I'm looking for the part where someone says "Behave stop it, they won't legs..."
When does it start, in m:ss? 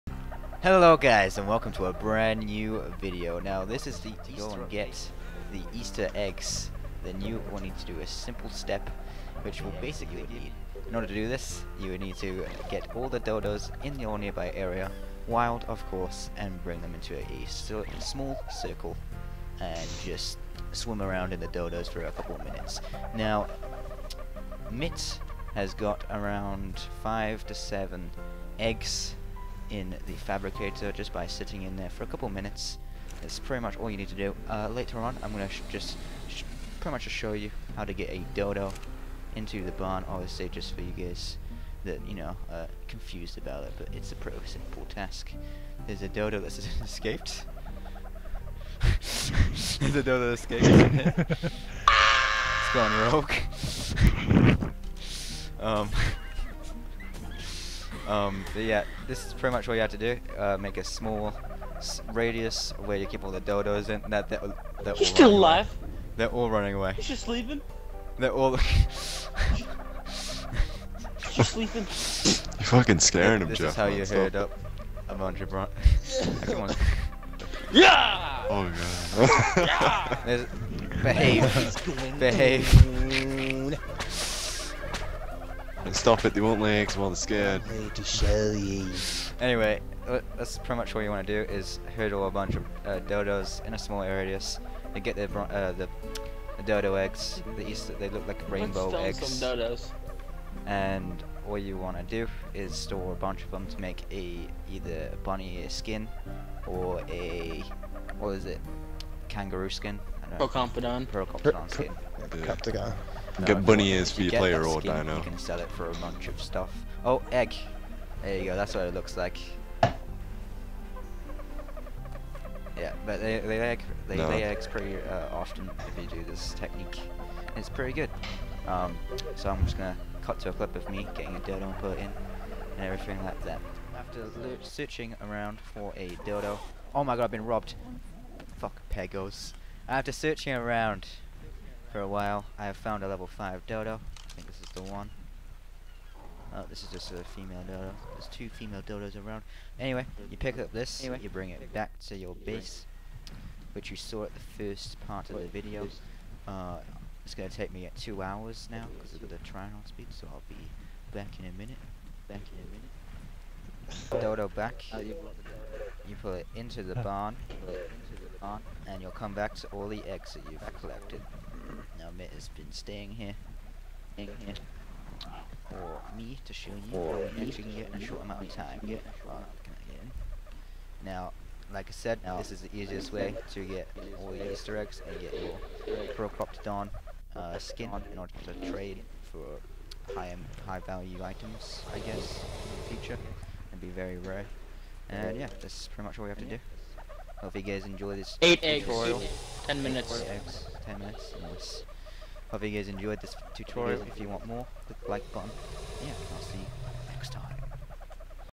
1:22.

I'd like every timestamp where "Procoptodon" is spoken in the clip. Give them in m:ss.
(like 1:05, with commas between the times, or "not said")
1:50, 3:06.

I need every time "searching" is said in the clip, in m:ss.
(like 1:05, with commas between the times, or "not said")
2:14, 2:20.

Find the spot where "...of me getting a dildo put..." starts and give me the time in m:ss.
2:10.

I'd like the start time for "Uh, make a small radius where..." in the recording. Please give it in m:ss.
1:00.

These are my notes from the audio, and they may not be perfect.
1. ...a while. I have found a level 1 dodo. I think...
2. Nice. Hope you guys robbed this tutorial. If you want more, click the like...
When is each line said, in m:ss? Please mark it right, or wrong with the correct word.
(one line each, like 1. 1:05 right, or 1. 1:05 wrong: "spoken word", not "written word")
1. 2:21 wrong: "5", not "1"
2. 3:21 wrong: "enjoyed", not "robbed".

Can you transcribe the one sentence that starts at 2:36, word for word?
Uh, it's going to take me two hours now because of the trial speed, so I'll be back in a minute.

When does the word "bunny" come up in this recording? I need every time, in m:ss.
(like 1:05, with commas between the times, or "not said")
1:45, 1:53.